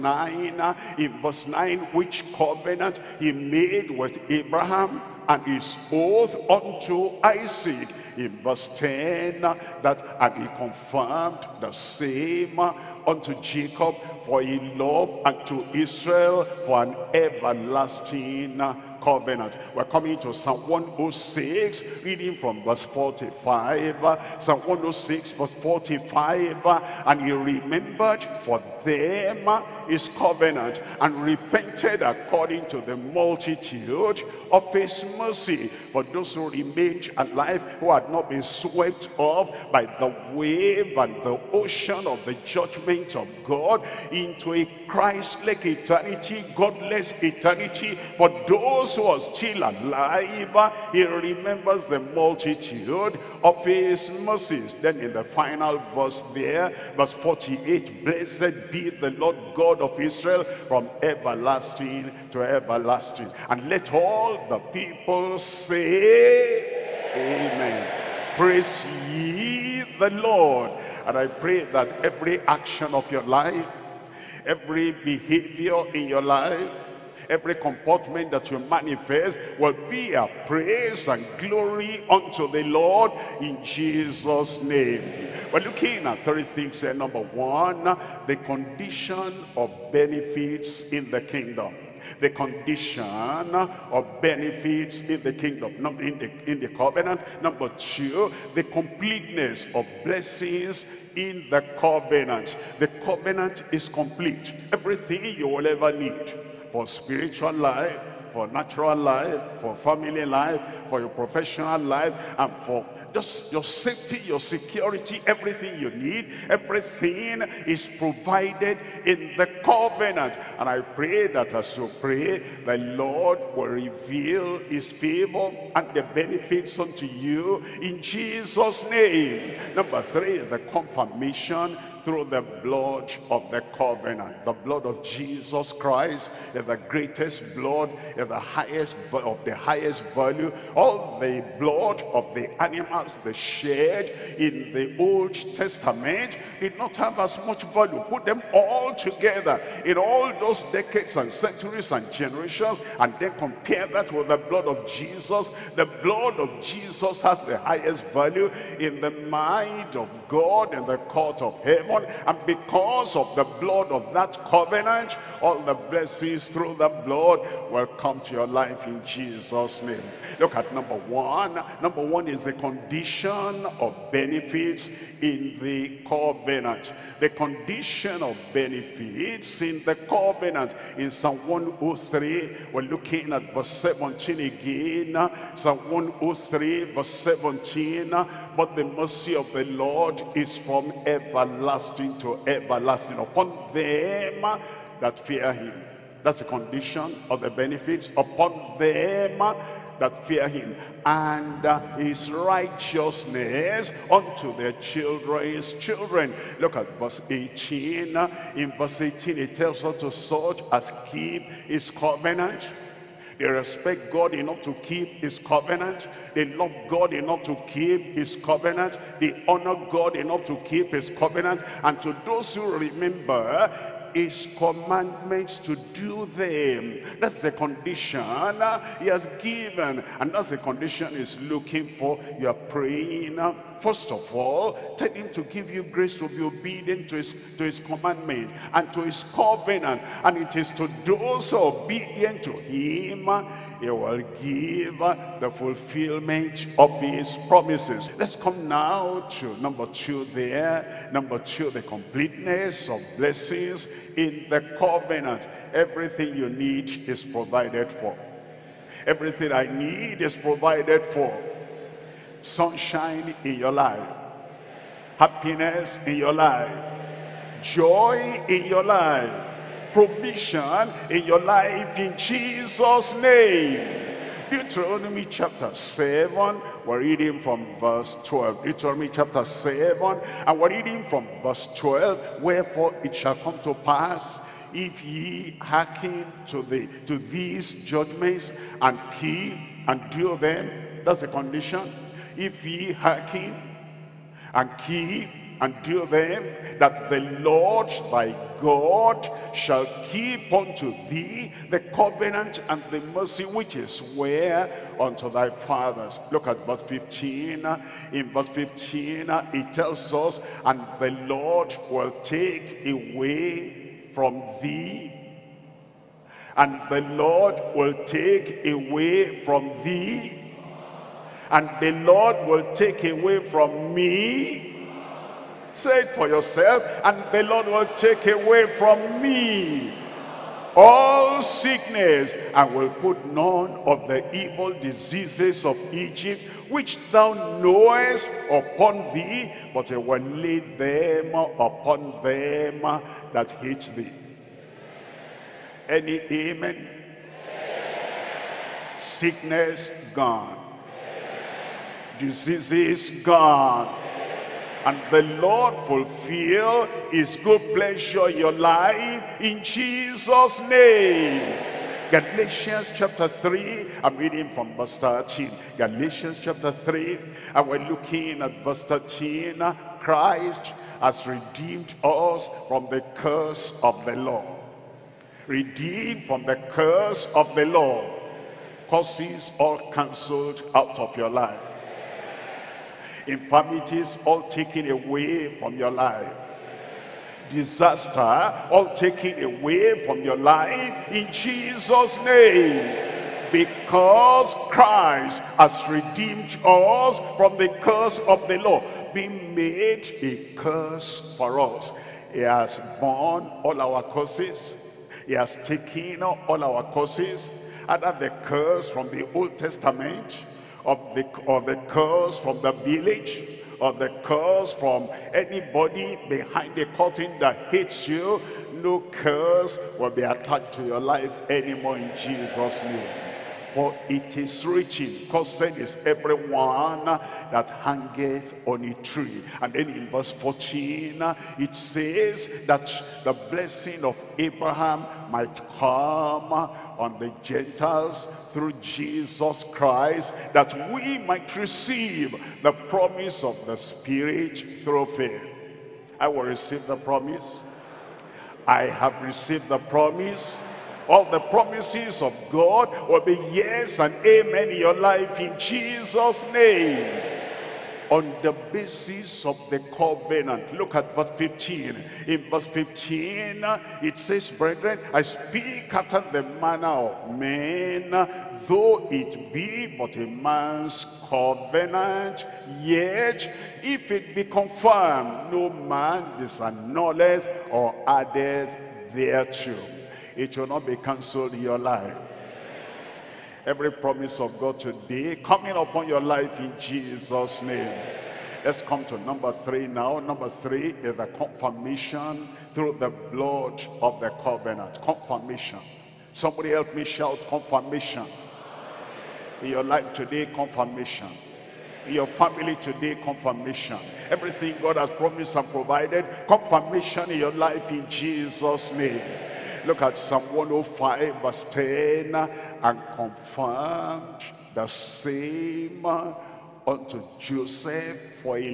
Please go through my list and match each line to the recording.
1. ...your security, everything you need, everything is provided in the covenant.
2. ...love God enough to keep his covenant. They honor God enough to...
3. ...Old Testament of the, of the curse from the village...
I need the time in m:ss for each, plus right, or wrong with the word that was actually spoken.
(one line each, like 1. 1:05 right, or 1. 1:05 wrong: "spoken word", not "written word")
1. 1:54 right
2. 3:36 right
3. 6:49 right.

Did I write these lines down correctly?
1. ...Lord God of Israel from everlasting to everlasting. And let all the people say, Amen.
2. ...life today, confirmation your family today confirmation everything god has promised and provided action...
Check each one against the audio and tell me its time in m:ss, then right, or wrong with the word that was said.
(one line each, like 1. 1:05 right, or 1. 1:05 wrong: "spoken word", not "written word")
1. 0:59 right
2. 8:19 wrong: "confirmation", not "action".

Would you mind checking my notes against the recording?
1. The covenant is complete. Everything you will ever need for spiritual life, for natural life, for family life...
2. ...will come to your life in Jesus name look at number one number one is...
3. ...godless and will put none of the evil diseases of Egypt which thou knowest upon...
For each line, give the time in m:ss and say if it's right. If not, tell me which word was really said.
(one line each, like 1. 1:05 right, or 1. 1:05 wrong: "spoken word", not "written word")
1. 1:42 right
2. 2:47 right
3. 5:31 wrong: "sickness", not "godless".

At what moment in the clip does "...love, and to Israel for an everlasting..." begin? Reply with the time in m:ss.
0:14.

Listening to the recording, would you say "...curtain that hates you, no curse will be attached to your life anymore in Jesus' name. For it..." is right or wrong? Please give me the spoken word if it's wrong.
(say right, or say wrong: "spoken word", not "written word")
right.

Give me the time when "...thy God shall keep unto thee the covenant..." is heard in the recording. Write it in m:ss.
4:58.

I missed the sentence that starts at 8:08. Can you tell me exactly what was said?
Let's come to number three now.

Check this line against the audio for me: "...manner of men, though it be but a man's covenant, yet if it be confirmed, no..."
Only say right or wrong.
right.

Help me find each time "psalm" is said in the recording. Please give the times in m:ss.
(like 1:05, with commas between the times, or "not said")
0:20, 0:24, 3:01, 3:05, 8:30.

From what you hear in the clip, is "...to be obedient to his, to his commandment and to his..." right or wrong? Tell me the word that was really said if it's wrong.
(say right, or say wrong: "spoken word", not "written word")
right.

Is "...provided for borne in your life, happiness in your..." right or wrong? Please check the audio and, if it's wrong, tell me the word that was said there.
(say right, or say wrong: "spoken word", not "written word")
wrong: "sunshine", not "borne".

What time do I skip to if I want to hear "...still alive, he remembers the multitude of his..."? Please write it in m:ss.
0:49.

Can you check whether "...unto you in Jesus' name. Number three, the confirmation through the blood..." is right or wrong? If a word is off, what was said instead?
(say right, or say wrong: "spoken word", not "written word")
right.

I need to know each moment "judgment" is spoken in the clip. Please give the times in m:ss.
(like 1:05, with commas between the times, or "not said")
0:42, 4:47.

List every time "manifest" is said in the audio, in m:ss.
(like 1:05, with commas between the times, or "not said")
1:18.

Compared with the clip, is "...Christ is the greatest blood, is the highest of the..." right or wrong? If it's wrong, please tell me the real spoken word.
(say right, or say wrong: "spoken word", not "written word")
right.